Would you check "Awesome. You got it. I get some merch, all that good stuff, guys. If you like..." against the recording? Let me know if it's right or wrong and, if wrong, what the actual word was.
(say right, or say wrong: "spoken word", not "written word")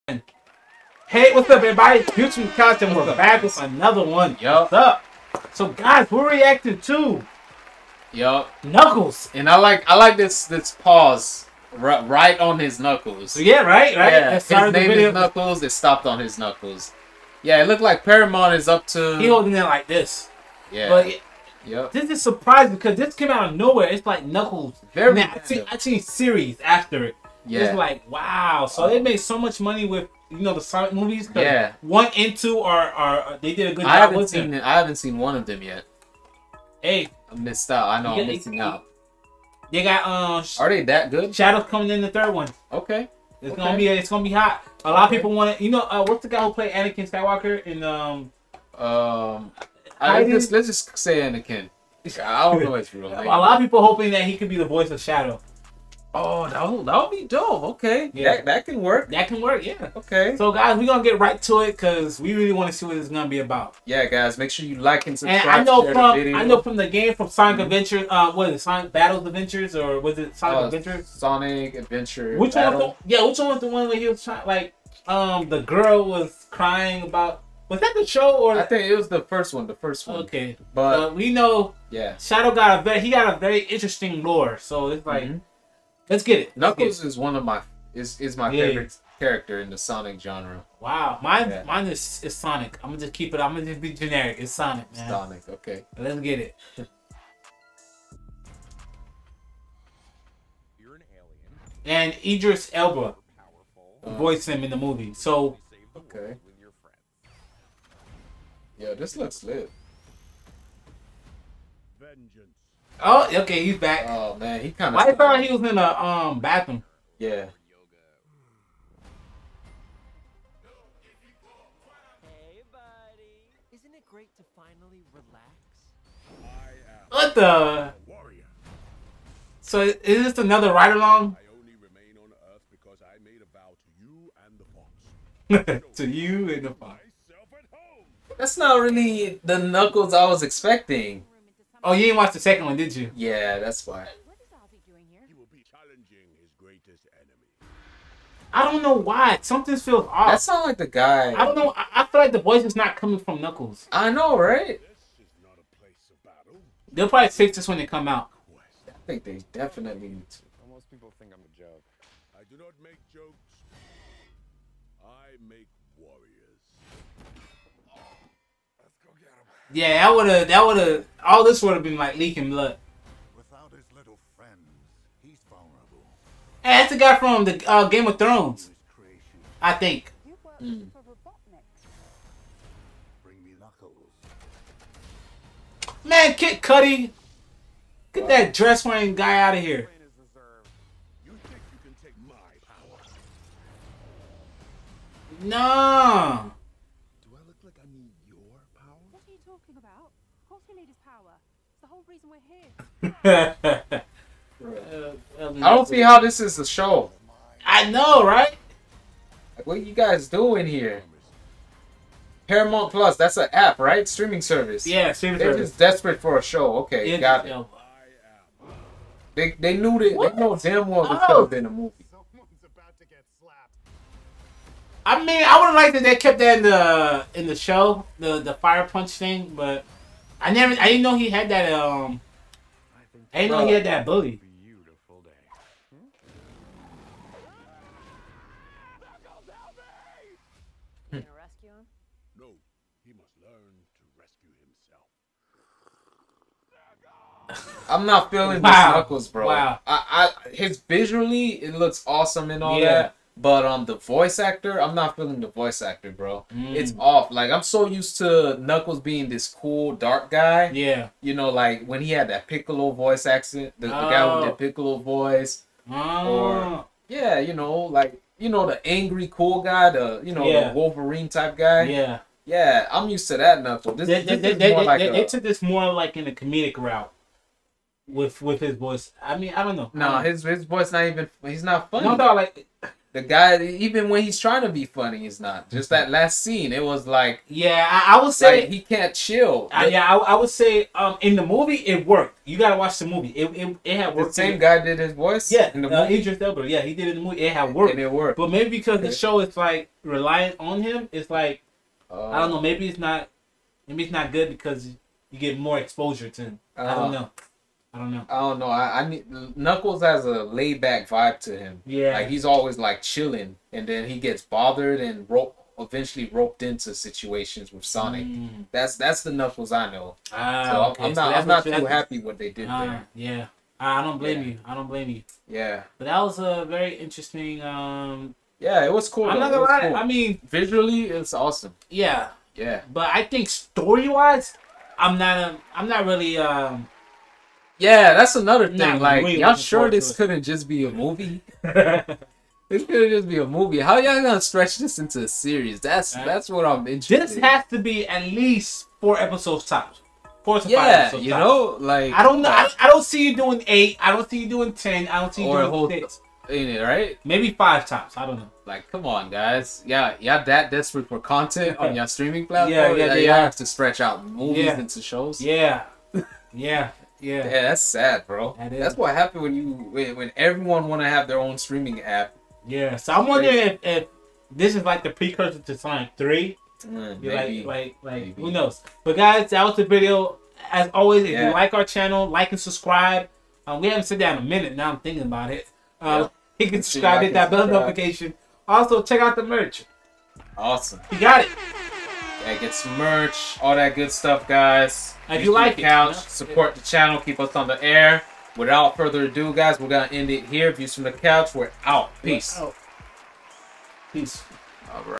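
right.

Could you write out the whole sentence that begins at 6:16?
Mm, maybe, like like like maybe.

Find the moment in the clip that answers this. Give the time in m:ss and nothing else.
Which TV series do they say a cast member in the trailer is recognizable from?
2:57.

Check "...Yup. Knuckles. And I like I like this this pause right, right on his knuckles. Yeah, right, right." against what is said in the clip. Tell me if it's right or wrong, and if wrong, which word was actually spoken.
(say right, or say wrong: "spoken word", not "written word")
right.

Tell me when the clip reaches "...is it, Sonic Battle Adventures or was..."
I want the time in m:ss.
1:08.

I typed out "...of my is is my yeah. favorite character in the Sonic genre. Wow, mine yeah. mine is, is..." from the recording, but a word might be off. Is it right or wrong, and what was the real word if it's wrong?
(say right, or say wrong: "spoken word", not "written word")
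right.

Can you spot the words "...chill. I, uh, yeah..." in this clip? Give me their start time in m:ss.
4:49.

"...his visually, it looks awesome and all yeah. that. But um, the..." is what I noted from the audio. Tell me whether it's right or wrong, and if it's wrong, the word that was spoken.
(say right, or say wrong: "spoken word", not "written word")
right.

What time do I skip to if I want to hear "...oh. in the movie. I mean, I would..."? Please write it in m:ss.
3:41.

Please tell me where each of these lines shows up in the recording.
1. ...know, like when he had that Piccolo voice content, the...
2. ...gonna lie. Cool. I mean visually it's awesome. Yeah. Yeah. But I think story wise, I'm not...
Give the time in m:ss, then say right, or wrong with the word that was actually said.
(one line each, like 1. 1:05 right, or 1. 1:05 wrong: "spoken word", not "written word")
1. 4:21 wrong: "accent", not "content"
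2. 5:29 right.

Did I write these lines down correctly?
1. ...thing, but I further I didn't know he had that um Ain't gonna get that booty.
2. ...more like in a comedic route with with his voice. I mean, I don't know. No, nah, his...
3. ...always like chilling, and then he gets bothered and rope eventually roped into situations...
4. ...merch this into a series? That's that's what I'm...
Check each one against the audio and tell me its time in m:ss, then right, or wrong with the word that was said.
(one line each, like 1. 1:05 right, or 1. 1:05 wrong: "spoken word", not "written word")
1. 3:49 wrong: "never", not "further"
2. 4:35 right
3. 5:12 right
4. 5:44 wrong: "stretch", not "merch".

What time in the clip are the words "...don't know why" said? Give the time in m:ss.
2:28.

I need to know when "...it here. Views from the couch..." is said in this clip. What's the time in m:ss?
6:40.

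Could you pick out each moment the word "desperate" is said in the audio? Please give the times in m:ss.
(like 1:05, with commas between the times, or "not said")
3:35, 6:00.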